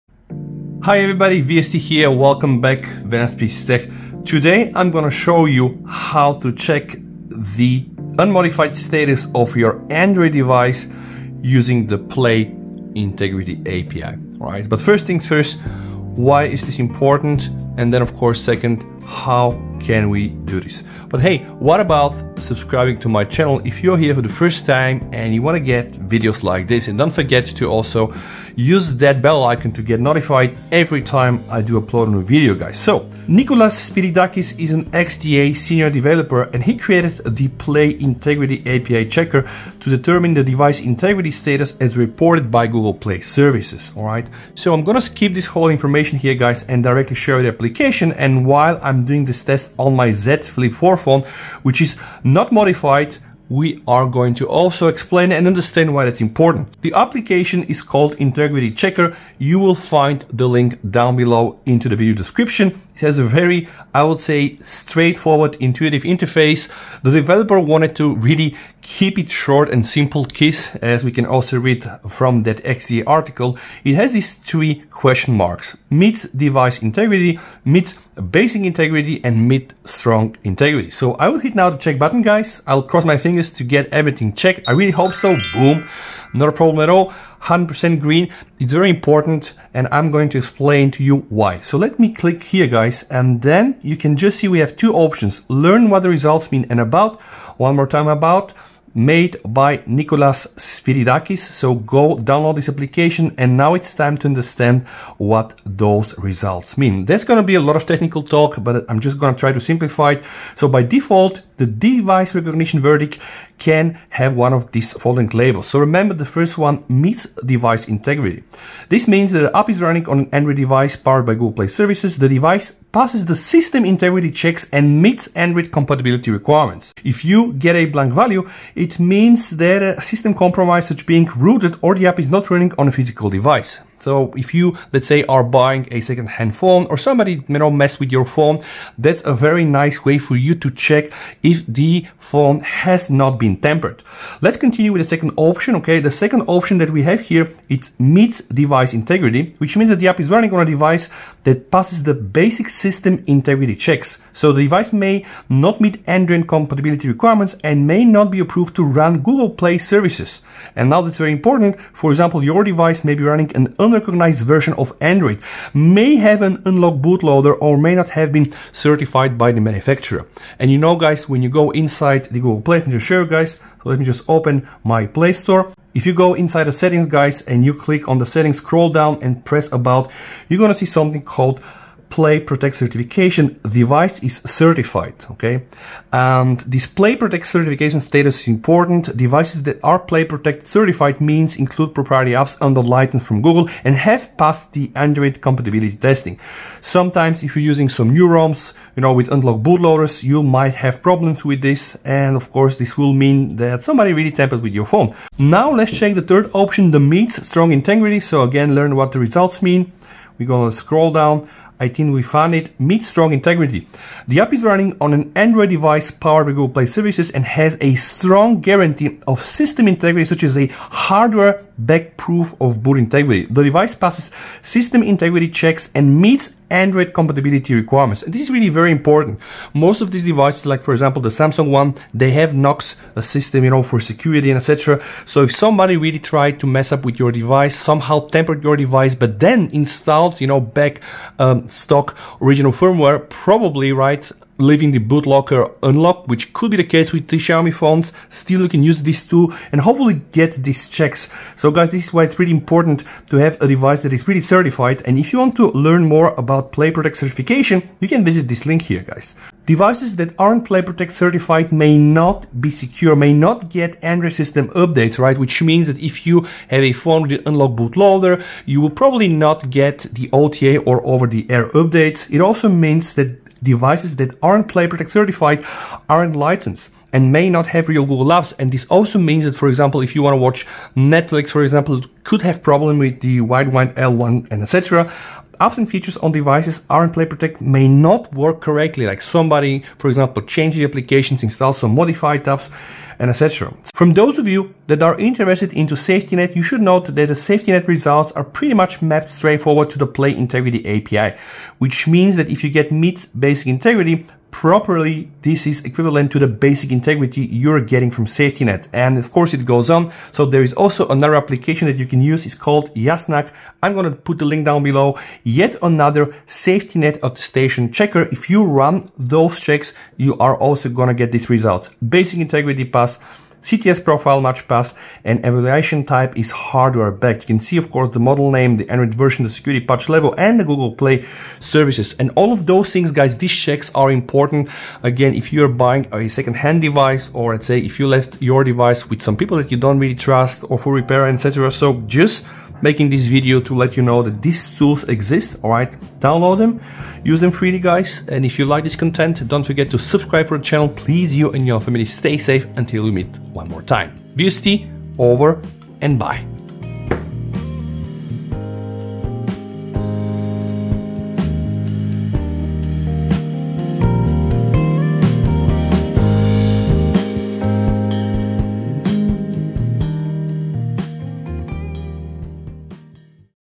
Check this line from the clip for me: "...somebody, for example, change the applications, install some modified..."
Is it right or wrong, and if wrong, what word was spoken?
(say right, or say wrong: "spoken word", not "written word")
right.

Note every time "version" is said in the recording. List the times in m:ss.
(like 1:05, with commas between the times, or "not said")
2:44, 5:29.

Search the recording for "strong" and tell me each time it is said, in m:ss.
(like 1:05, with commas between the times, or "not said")
1:19, 3:27, 3:33, 3:37.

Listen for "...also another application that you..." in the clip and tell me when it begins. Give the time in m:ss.
5:10.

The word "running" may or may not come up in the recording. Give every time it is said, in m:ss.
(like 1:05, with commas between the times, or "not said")
1:59, 2:12, 2:30, 2:43, 3:34.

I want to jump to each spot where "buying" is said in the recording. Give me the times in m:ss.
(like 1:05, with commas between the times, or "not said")
2:15, 5:35.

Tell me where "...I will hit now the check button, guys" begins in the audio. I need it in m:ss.
1:21.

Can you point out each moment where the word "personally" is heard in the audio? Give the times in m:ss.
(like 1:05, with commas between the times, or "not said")
not said.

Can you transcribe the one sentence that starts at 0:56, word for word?
The application is called Integrity Checker.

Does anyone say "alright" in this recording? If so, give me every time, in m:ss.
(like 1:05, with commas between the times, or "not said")
0:43, 5:45.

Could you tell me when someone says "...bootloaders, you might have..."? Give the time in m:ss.
3:19.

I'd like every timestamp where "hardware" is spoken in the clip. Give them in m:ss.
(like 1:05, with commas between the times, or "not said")
3:40, 5:26.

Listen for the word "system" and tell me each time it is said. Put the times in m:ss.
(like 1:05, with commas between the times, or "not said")
2:03, 2:10, 2:32, 3:39, 3:44, 3:53, 4:24.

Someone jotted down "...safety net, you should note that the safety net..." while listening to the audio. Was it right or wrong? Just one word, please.
right.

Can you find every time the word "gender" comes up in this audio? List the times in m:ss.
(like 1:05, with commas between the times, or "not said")
not said.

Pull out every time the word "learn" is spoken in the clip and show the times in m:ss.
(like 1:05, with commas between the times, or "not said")
1:35, 3:28, 4:15.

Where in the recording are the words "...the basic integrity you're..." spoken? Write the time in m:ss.
5:06.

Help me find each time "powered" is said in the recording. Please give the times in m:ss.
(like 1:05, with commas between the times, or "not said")
2:00, 3:36.